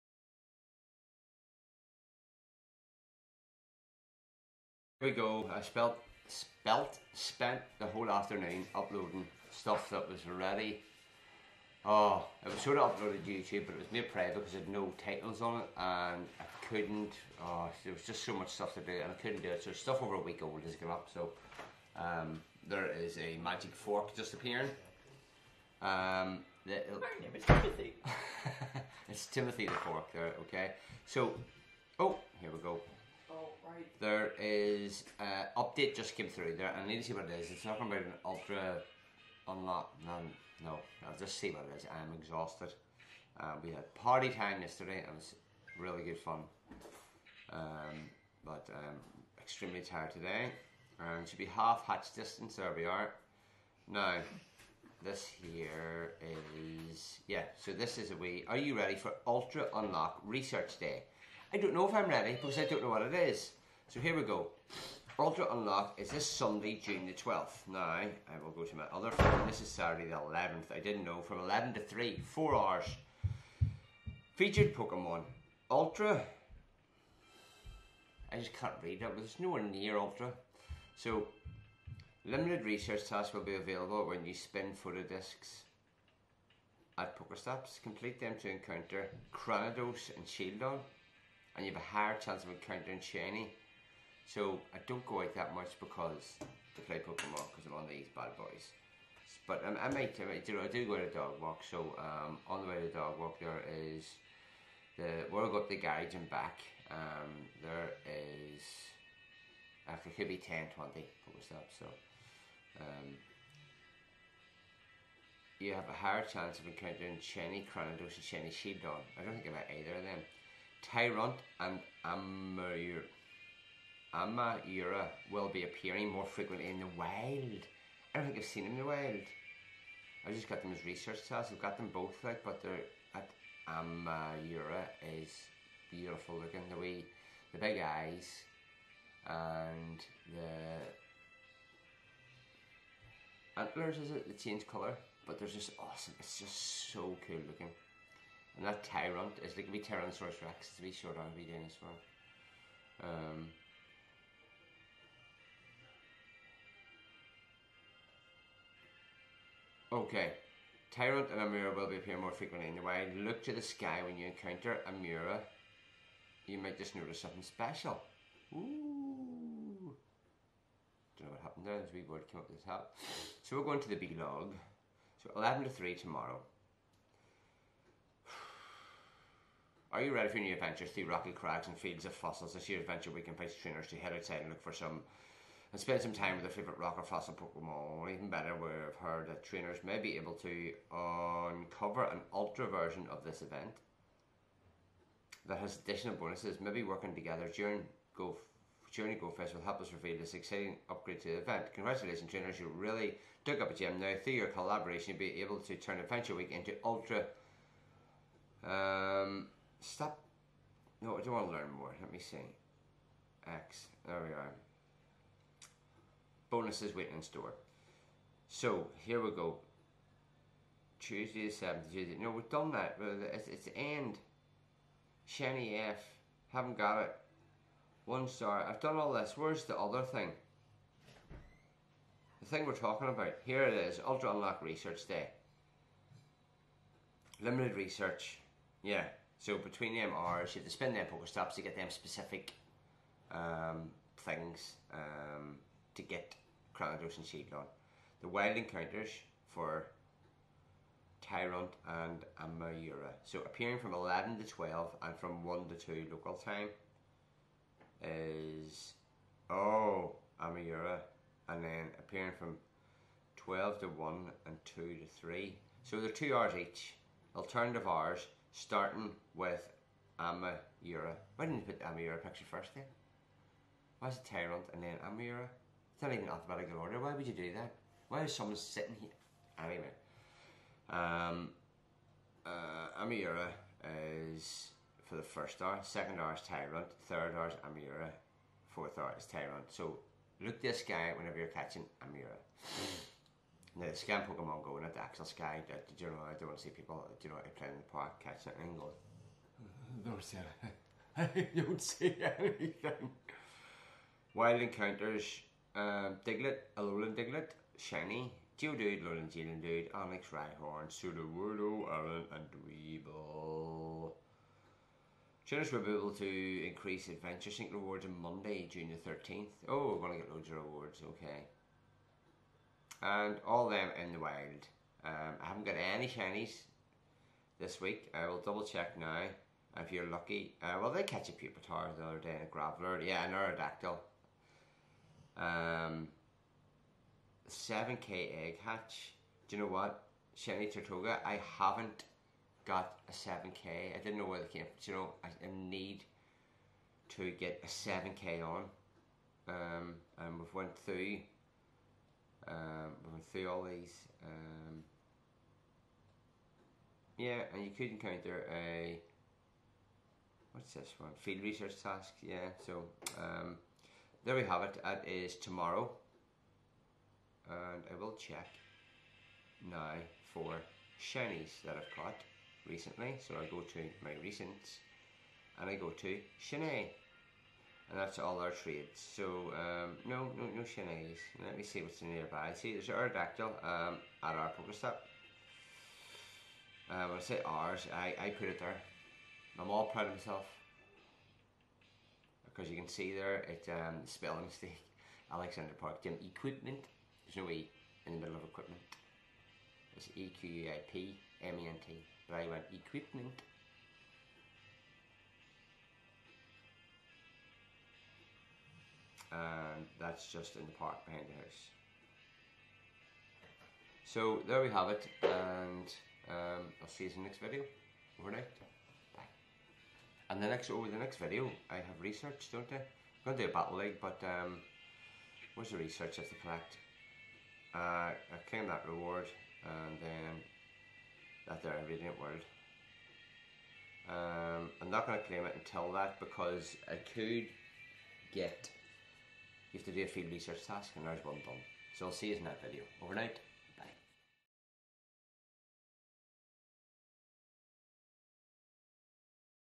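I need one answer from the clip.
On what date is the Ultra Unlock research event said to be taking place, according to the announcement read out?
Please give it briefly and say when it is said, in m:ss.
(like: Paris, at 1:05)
June 12th, at 1:06.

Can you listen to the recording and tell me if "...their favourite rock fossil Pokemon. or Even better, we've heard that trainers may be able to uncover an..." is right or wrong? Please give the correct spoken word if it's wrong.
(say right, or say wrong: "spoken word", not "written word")
right.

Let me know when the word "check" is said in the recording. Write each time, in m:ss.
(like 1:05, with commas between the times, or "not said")
5:28, 6:08.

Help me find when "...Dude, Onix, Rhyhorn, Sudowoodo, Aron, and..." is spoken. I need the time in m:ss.
5:09.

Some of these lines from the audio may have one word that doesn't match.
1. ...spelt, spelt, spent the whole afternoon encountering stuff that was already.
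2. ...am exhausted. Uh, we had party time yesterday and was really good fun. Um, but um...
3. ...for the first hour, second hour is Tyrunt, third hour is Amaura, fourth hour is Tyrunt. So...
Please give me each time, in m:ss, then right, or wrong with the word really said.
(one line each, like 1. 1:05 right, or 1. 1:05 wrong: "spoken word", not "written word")
1. 0:05 wrong: "uploading", not "encountering"
2. 0:42 right
3. 4:45 right.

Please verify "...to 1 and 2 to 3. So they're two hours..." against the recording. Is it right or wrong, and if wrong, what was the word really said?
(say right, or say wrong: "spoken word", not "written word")
right.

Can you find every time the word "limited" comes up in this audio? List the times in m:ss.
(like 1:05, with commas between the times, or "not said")
1:22, 3:57.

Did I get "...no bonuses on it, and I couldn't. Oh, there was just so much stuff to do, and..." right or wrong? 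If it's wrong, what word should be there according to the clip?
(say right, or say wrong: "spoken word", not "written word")
wrong: "titles", not "bonuses".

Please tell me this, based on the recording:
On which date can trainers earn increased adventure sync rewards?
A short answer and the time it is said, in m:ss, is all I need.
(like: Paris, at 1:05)
Monday, June 13th, at 5:18.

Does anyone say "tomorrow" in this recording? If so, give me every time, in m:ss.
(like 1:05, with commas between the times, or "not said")
2:55, 6:05.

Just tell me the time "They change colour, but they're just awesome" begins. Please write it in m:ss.
2:24.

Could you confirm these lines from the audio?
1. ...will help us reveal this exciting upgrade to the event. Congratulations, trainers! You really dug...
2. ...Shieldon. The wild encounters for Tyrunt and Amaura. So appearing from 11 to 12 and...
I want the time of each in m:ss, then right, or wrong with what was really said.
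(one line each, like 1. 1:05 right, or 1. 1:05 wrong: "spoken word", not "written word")
1. 3:19 right
2. 4:07 right.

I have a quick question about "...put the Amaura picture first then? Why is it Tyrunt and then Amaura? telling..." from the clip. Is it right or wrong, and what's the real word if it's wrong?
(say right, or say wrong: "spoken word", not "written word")
right.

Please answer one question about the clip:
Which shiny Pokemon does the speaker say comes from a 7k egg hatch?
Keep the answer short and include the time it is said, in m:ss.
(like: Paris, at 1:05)
Tirtouga, at 5:40.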